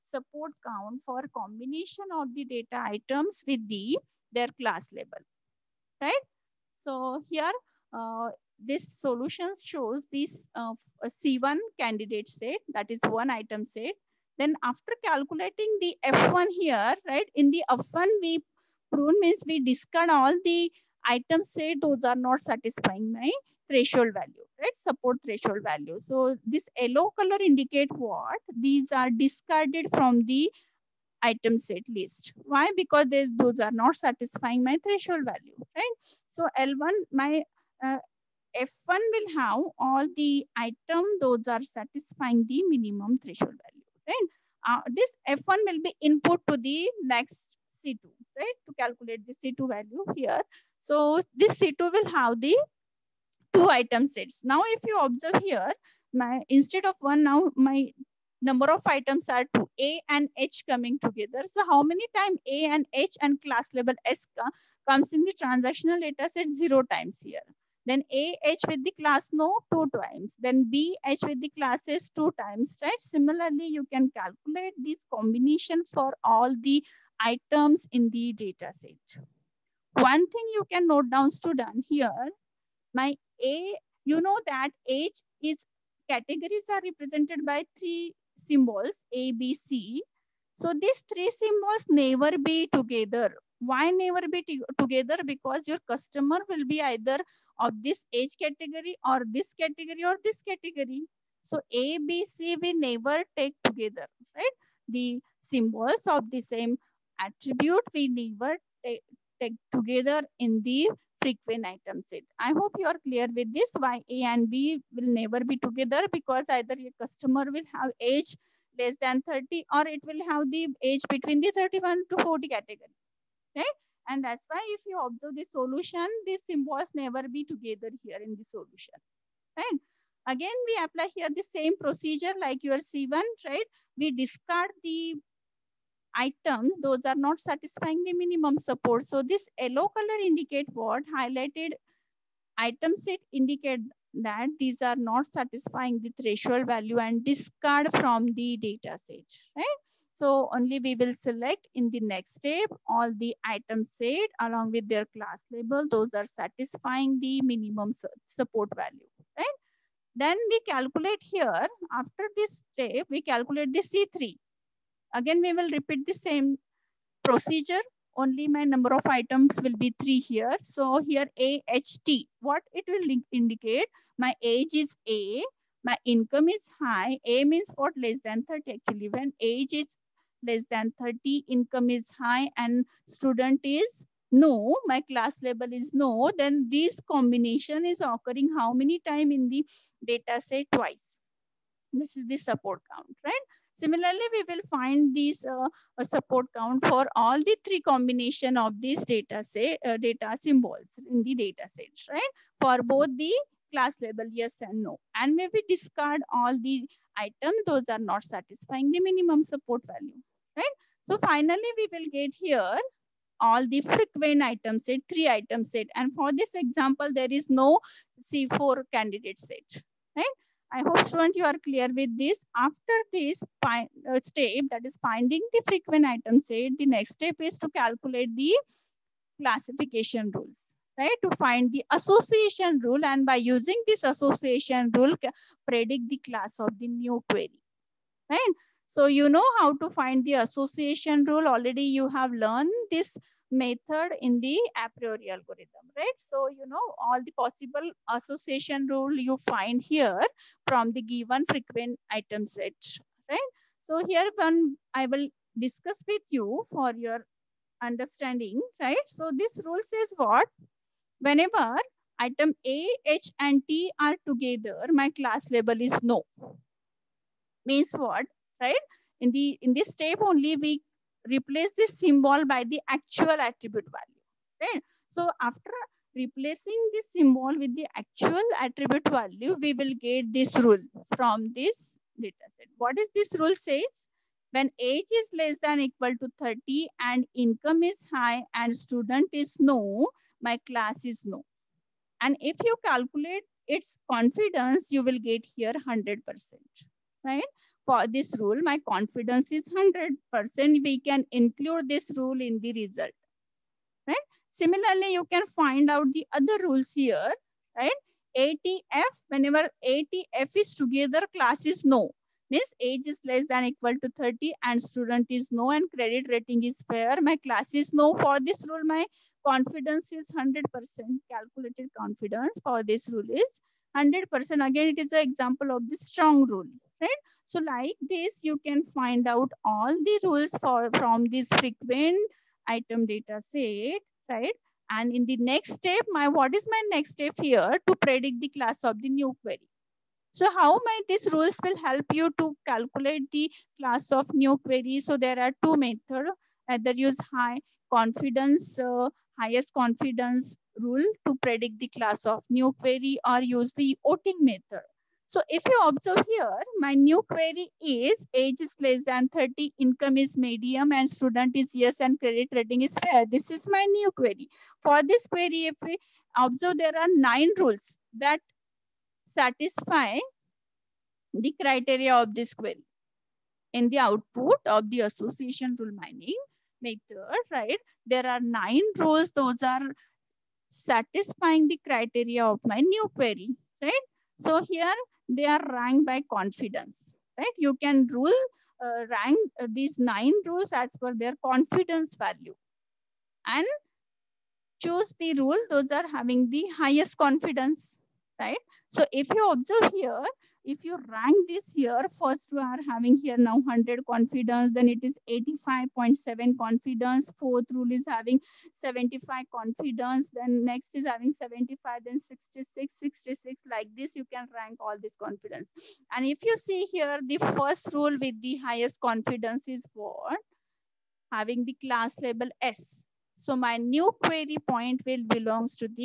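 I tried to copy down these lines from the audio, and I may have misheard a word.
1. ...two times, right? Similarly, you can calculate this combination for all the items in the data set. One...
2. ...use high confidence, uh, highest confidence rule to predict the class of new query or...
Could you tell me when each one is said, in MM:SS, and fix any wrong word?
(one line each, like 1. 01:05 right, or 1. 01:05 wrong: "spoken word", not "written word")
1. 01:12 right
2. 05:46 right.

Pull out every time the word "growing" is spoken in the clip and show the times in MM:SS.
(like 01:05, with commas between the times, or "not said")
not said.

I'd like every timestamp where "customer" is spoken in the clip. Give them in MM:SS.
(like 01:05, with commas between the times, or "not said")
01:35, 01:56.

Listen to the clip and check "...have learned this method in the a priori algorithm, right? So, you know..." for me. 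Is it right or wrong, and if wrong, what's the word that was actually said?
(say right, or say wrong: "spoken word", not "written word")
right.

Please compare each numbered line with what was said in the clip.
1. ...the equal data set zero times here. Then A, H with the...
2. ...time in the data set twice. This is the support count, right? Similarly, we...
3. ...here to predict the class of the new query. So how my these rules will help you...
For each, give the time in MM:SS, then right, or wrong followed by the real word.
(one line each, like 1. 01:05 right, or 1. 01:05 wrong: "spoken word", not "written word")
1. 01:05 wrong: "transactional", not "equal"
2. 03:08 right
3. 05:37 right.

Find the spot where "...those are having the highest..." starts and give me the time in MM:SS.
06:35.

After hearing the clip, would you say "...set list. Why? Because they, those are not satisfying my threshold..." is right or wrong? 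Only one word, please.
right.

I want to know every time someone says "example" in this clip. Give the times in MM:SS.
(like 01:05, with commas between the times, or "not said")
03:36, 05:25.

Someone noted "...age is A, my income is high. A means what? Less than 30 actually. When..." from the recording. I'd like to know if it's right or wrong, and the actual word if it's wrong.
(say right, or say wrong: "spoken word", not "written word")
right.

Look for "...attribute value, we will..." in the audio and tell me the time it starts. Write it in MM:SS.
04:38.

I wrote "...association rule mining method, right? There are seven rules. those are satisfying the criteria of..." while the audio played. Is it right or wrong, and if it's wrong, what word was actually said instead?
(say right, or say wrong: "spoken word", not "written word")
wrong: "nine", not "seven".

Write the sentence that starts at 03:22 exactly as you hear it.
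For both the class label yes and no.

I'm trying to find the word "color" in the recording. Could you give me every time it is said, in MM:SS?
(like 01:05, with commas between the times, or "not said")
00:27, 02:19.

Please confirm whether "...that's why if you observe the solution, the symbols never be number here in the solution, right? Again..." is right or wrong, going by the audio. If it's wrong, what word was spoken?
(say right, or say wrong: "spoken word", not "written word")
wrong: "together", not "number".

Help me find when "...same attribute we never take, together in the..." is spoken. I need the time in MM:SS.
01:46.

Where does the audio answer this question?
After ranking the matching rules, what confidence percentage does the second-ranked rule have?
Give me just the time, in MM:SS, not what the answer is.
06:45.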